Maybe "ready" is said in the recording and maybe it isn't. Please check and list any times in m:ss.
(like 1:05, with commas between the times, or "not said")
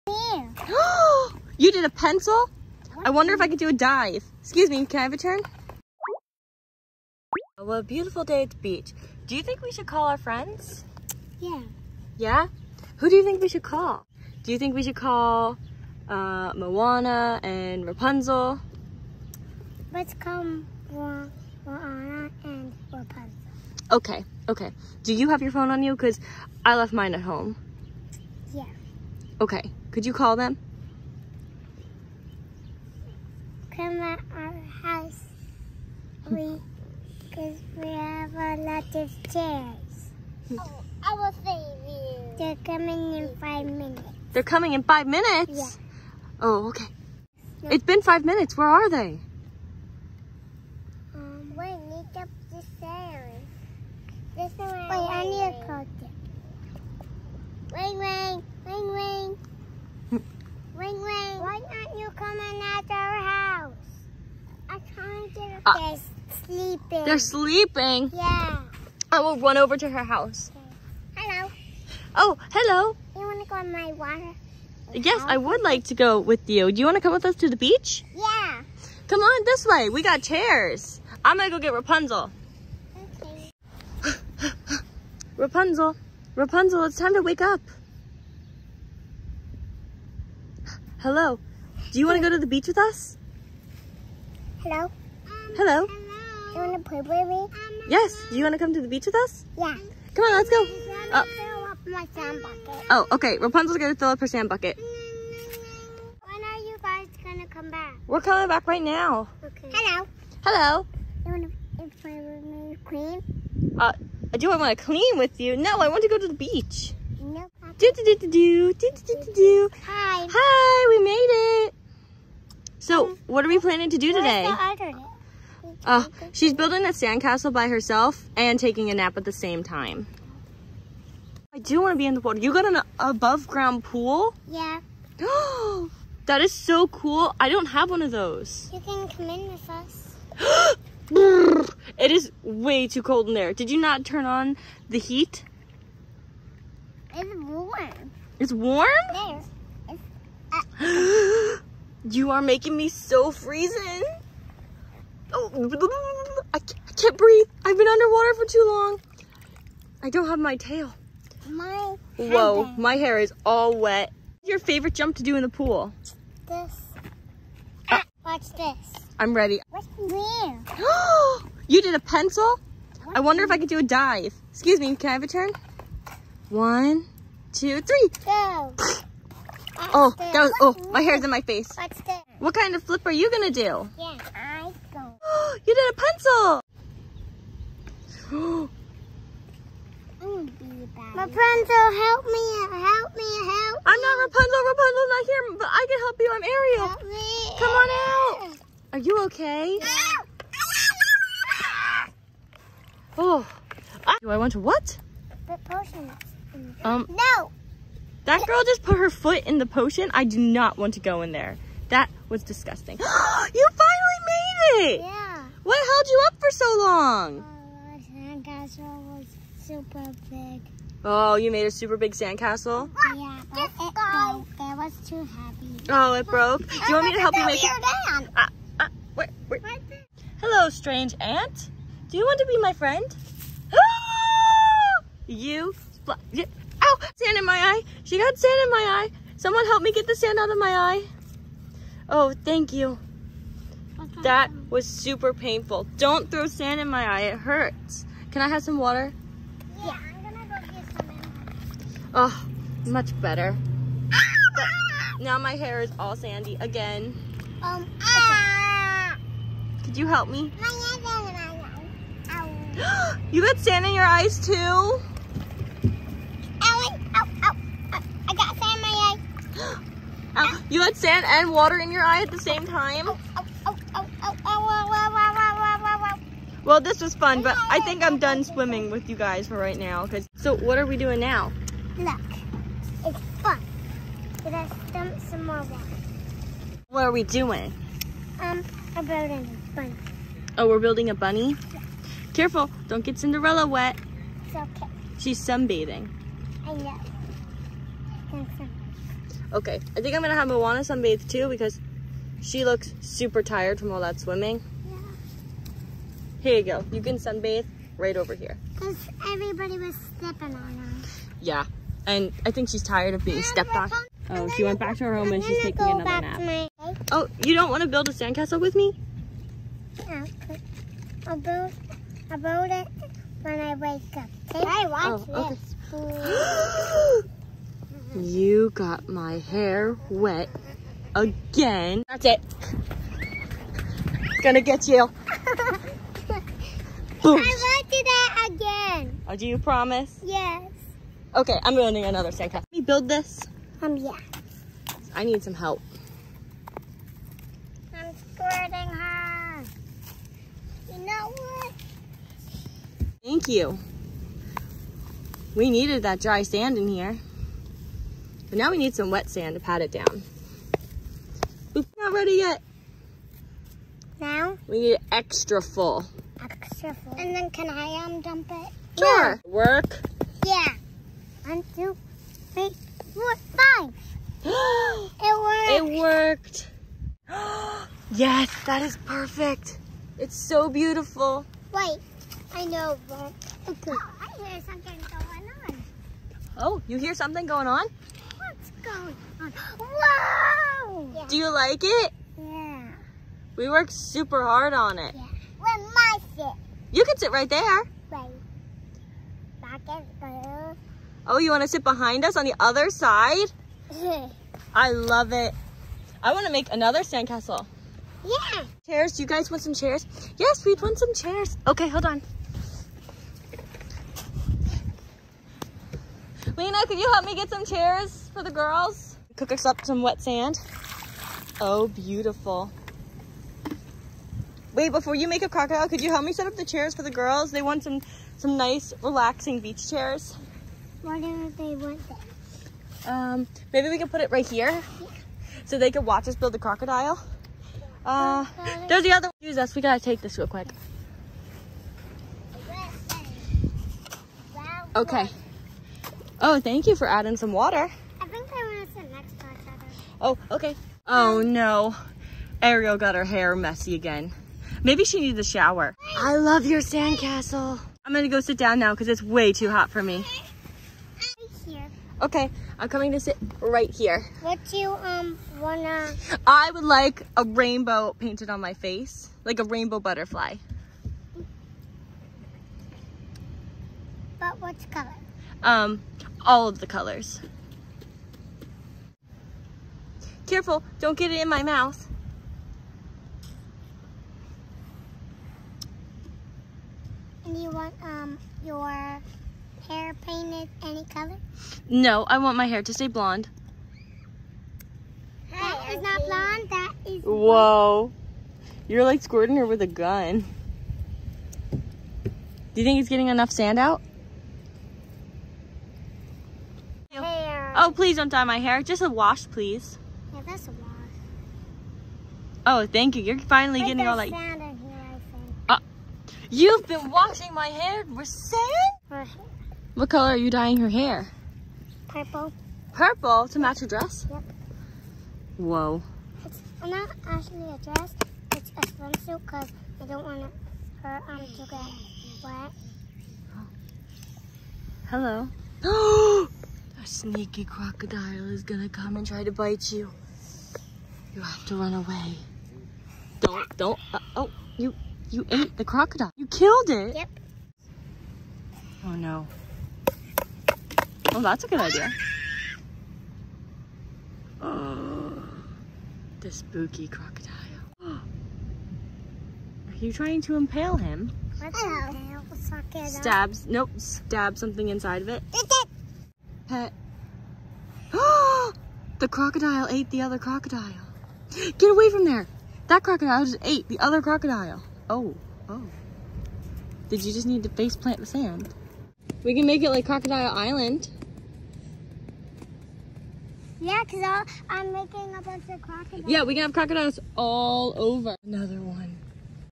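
2:49, 6:02.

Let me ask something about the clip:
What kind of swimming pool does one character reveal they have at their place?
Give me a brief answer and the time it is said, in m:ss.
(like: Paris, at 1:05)
Above ground pool, at 2:12.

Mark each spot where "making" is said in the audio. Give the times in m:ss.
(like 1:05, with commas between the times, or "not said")
2:32, 9:44.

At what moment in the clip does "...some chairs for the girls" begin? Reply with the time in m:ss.
6:57.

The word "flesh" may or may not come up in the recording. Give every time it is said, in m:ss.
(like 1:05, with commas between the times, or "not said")
not said.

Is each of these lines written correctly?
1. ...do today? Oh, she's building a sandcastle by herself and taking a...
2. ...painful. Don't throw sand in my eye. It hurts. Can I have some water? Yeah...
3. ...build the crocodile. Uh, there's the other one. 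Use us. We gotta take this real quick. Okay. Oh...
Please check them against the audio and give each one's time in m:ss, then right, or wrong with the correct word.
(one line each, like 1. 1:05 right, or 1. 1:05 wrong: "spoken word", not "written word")
1. 2:03 right
2. 4:05 right
3. 7:16 right.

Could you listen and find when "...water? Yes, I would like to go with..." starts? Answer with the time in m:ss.
1:13.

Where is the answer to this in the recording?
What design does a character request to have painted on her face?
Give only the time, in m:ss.
7:49.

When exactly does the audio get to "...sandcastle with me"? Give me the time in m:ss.
5:18.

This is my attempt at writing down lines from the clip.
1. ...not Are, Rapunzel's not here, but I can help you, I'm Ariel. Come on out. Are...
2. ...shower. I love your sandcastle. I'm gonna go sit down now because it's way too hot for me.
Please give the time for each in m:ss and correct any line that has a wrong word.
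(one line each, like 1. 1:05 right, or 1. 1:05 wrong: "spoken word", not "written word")
1. 3:14 wrong: "Rapunzel", not "Are"
2. 7:35 right.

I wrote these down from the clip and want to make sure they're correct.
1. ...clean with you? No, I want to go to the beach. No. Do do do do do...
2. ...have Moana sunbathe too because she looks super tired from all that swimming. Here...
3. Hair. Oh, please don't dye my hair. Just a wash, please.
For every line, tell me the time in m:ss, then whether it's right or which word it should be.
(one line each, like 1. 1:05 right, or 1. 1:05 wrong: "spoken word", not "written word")
1. 1:54 right
2. 5:00 right
3. 8:27 right.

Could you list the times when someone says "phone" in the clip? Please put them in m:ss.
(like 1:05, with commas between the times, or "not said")
0:25.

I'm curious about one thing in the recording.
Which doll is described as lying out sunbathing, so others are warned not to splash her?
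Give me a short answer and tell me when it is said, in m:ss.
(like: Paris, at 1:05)
Cinderella, at 4:53.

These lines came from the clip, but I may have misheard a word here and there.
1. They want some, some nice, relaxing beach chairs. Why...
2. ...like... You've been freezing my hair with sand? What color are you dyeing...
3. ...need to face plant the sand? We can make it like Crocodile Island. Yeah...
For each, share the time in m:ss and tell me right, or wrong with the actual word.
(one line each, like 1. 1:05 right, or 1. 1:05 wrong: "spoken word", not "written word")
1. 7:07 right
2. 8:34 wrong: "washing", not "freezing"
3. 9:37 right.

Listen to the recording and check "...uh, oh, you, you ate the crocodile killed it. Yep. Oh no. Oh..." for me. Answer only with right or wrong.
right.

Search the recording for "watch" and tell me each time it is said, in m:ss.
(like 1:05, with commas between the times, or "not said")
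2:48, 5:24, 7:16.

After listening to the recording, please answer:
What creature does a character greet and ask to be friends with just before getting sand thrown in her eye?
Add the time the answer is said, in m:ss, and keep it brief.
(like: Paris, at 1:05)
Ant, at 3:50.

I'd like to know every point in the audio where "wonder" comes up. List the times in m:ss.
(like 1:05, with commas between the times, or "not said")
0:03, 2:53.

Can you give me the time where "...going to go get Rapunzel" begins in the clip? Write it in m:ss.
1:21.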